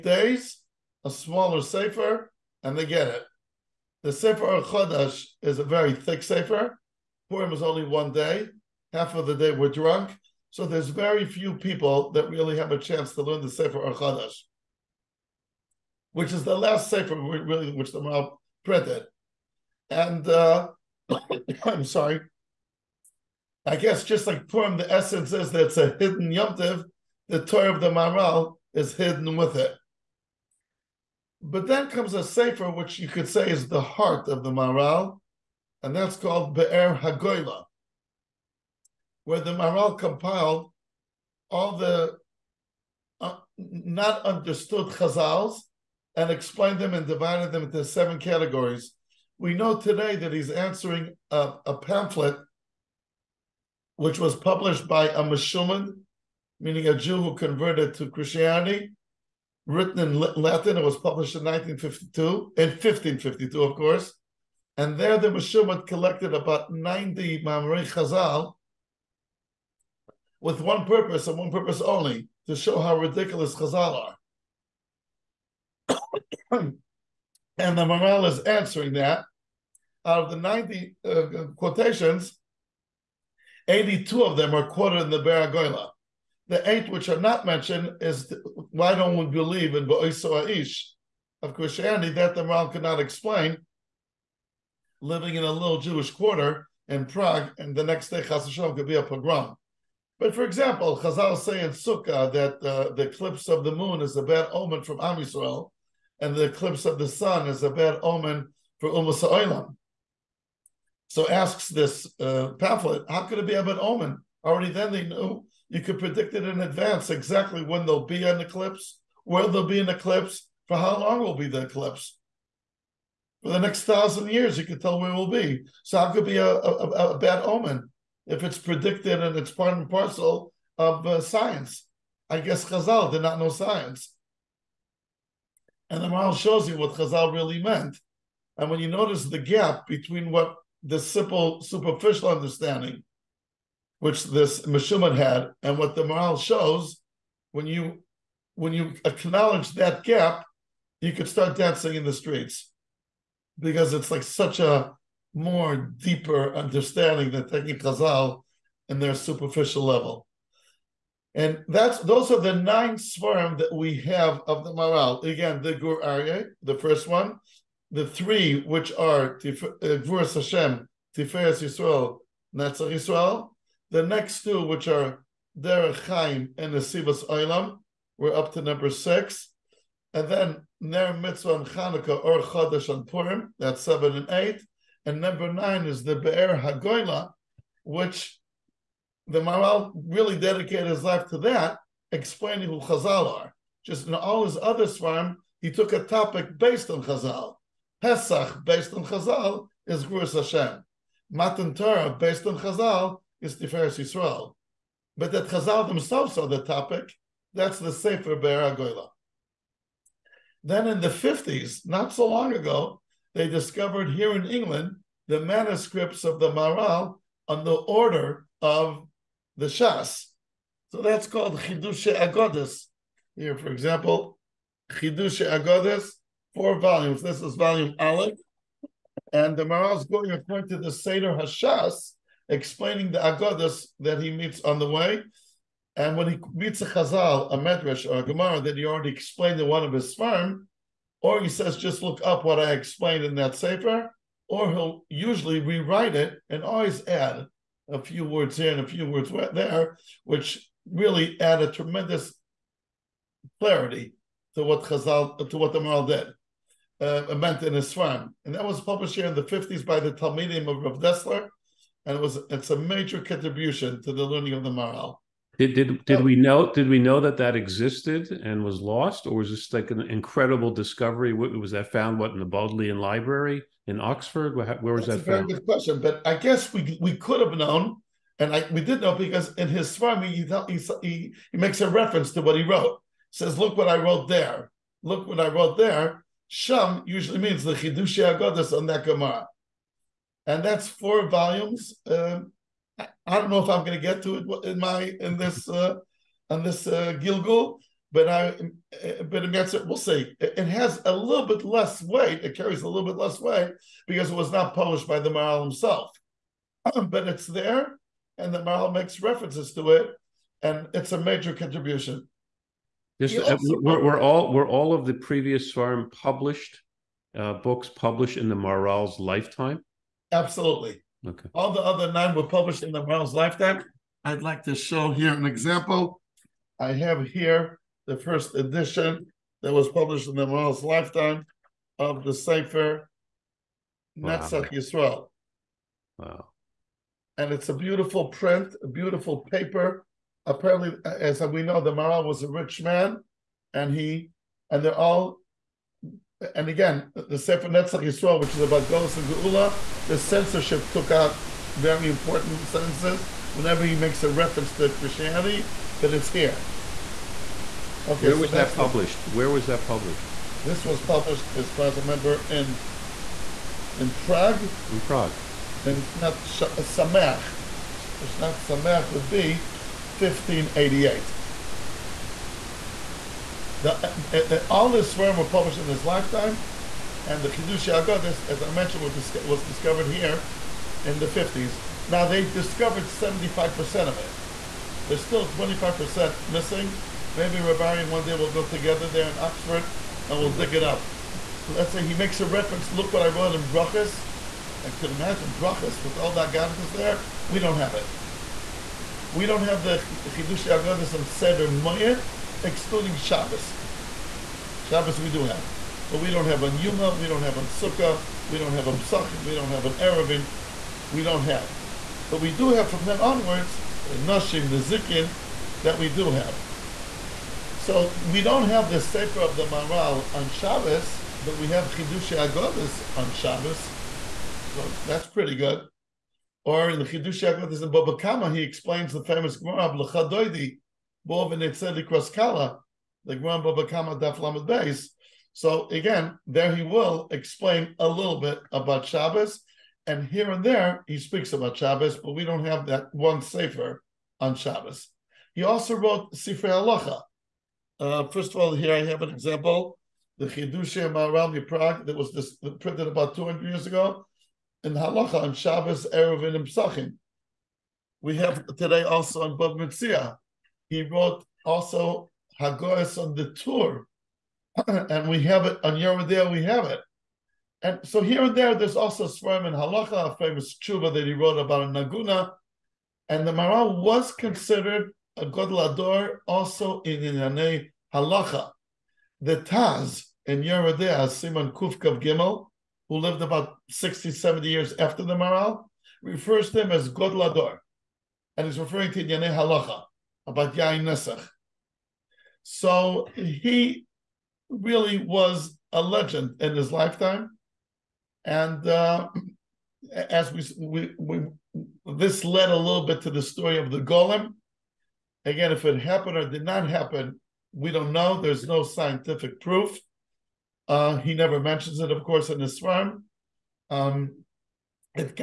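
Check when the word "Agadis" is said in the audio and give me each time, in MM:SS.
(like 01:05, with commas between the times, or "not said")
06:17, 06:40.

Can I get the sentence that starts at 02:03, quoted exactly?
For the next thousand years, you could tell where it will be.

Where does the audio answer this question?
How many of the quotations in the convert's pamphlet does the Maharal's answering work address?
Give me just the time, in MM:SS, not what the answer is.
01:23.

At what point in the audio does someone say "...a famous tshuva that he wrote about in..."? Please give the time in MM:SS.
07:50.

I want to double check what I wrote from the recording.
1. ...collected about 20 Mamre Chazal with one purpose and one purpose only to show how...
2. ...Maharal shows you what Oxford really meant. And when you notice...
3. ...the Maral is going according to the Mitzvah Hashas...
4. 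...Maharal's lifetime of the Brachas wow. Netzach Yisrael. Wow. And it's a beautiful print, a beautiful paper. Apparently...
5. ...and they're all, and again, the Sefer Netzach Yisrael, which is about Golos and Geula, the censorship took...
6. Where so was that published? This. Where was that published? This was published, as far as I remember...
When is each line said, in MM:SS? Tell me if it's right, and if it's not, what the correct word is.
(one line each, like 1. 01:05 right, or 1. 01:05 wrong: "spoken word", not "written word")
1. 01:05 wrong: "90", not "20"
2. 02:16 wrong: "Chazal", not "Oxford"
3. 03:49 wrong: "Seder", not "Mitzvah"
4. 05:30 wrong: "Sefer", not "Brachas"
5. 05:44 right
6. 05:58 right.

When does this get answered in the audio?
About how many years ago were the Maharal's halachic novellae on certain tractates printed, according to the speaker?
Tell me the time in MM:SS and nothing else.
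07:33.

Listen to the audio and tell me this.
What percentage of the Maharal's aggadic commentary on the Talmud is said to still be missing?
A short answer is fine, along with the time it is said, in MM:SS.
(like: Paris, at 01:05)
25%, at 06:25.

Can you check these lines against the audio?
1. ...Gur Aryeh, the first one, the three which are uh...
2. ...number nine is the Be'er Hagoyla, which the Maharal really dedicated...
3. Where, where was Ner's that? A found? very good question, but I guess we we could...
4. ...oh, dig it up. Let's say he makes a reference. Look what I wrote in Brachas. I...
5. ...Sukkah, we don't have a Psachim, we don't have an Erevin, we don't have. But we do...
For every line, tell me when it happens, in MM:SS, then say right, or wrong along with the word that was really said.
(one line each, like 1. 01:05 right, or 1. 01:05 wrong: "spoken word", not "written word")
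1. 02:45 right
2. 03:05 right
3. 04:34 wrong: "That", not "Ner"
4. 06:30 right
5. 06:47 right.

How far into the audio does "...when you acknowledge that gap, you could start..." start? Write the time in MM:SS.
02:28.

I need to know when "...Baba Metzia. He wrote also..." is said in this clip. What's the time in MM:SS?
07:39.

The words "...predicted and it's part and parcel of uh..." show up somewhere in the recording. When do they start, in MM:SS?
02:08.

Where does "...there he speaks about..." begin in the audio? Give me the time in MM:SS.
07:20.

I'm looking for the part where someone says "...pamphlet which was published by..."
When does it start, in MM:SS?
00:51.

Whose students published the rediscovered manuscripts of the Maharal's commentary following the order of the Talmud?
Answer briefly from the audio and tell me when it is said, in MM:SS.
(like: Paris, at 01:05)
Rav Dessler, at 04:20.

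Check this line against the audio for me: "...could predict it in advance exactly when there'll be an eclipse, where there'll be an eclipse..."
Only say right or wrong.
right.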